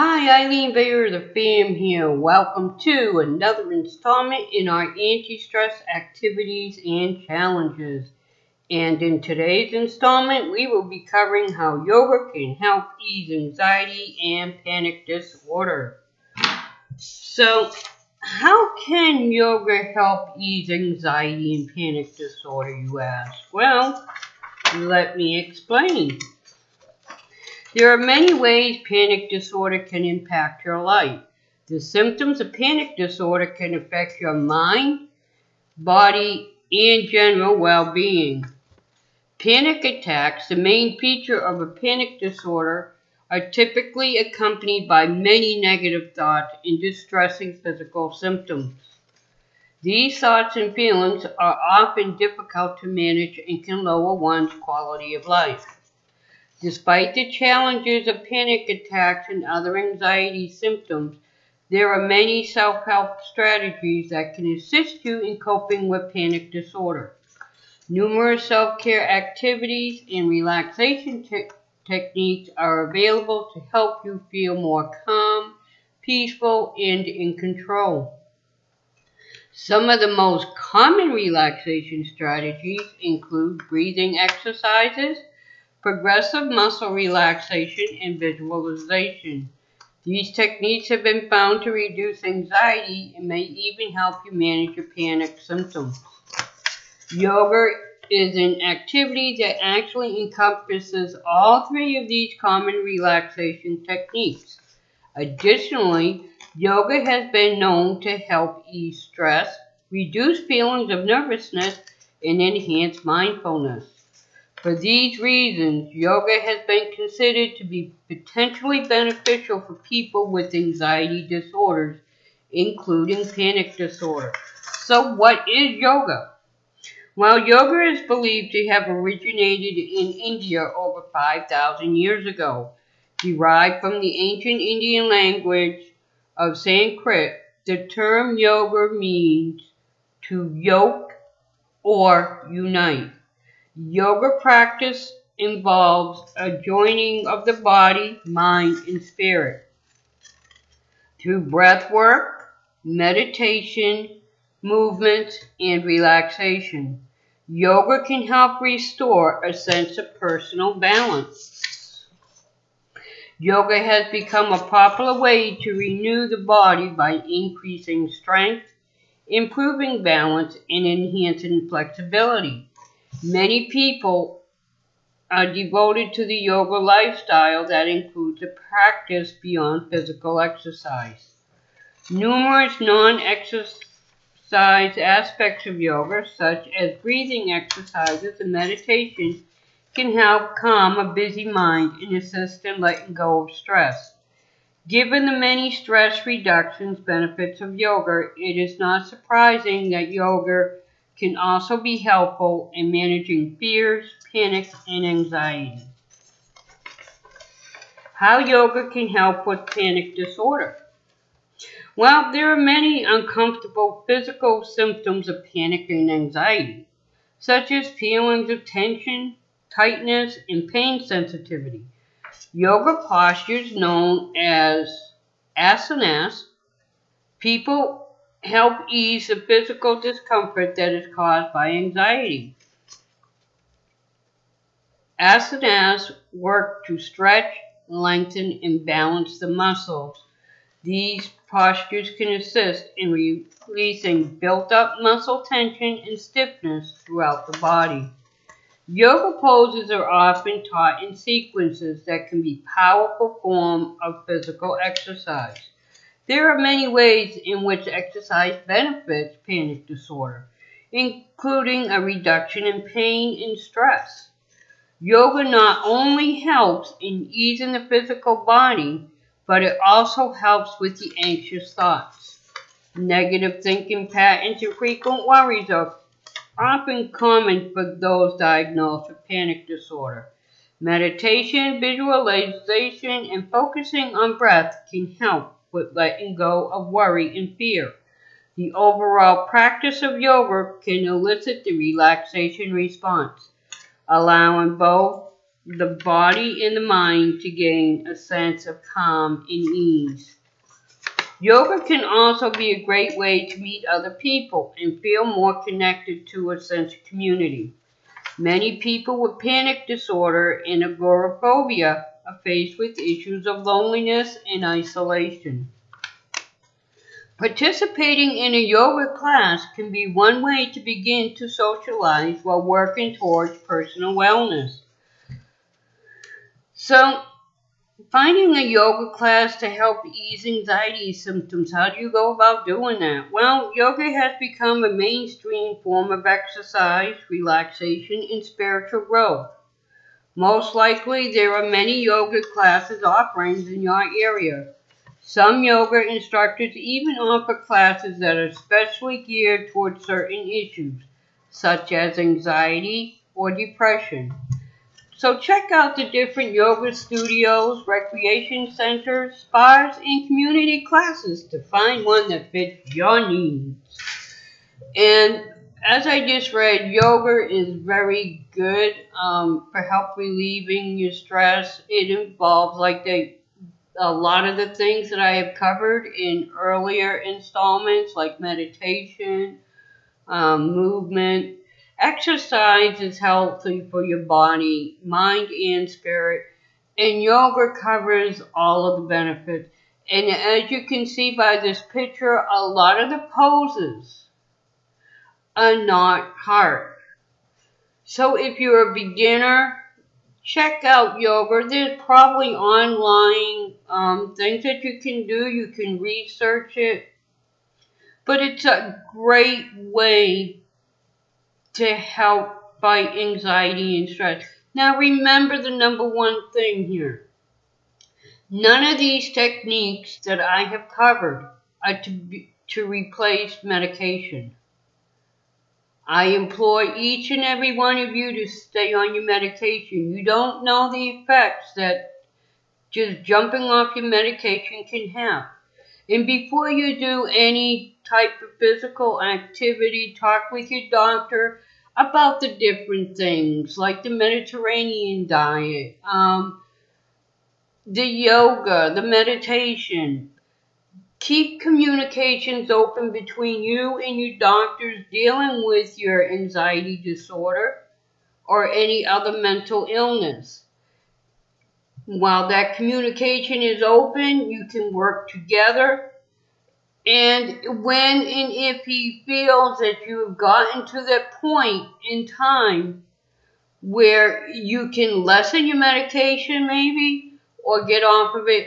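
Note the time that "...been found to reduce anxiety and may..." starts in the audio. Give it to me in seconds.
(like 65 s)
91 s.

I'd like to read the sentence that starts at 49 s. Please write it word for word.
These thoughts and feelings are often difficult to manage and can lower one's quality of life.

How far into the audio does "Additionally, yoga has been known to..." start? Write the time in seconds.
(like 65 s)
105 s.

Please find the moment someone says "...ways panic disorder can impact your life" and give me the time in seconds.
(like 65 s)
28 s.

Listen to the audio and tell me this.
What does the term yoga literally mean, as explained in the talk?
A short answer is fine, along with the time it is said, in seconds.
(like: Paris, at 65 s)
to yoke or unite, at 140 s.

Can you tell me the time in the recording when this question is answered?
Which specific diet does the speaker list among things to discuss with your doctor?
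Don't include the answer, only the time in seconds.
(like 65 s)
444 s.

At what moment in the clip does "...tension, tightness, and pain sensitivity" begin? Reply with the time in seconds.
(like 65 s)
218 s.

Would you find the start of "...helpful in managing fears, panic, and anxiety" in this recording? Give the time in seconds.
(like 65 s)
201 s.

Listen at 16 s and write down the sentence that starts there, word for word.
So, how can yoga help ease anxiety and panic disorder, you ask?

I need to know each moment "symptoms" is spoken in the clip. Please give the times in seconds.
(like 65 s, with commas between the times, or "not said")
31 s, 48 s, 60 s, 95 s, 214 s, 331 s.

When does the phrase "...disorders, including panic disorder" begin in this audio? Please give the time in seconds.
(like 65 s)
121 s.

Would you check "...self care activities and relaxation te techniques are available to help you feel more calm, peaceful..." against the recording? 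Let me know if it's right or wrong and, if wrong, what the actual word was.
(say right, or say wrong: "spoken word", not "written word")
right.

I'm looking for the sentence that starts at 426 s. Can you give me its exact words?
I implore each and every one of you to stay on your medication.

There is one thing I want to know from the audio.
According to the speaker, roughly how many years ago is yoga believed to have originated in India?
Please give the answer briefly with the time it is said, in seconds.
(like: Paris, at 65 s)
over 5,000 years, at 130 s.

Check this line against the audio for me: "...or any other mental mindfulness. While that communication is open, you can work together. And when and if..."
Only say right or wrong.
wrong.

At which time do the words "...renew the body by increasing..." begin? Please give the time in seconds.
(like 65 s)
165 s.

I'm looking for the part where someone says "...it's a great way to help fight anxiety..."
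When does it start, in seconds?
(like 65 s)
408 s.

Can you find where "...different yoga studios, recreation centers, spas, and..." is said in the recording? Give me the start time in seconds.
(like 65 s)
356 s.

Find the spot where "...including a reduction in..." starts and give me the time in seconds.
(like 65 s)
260 s.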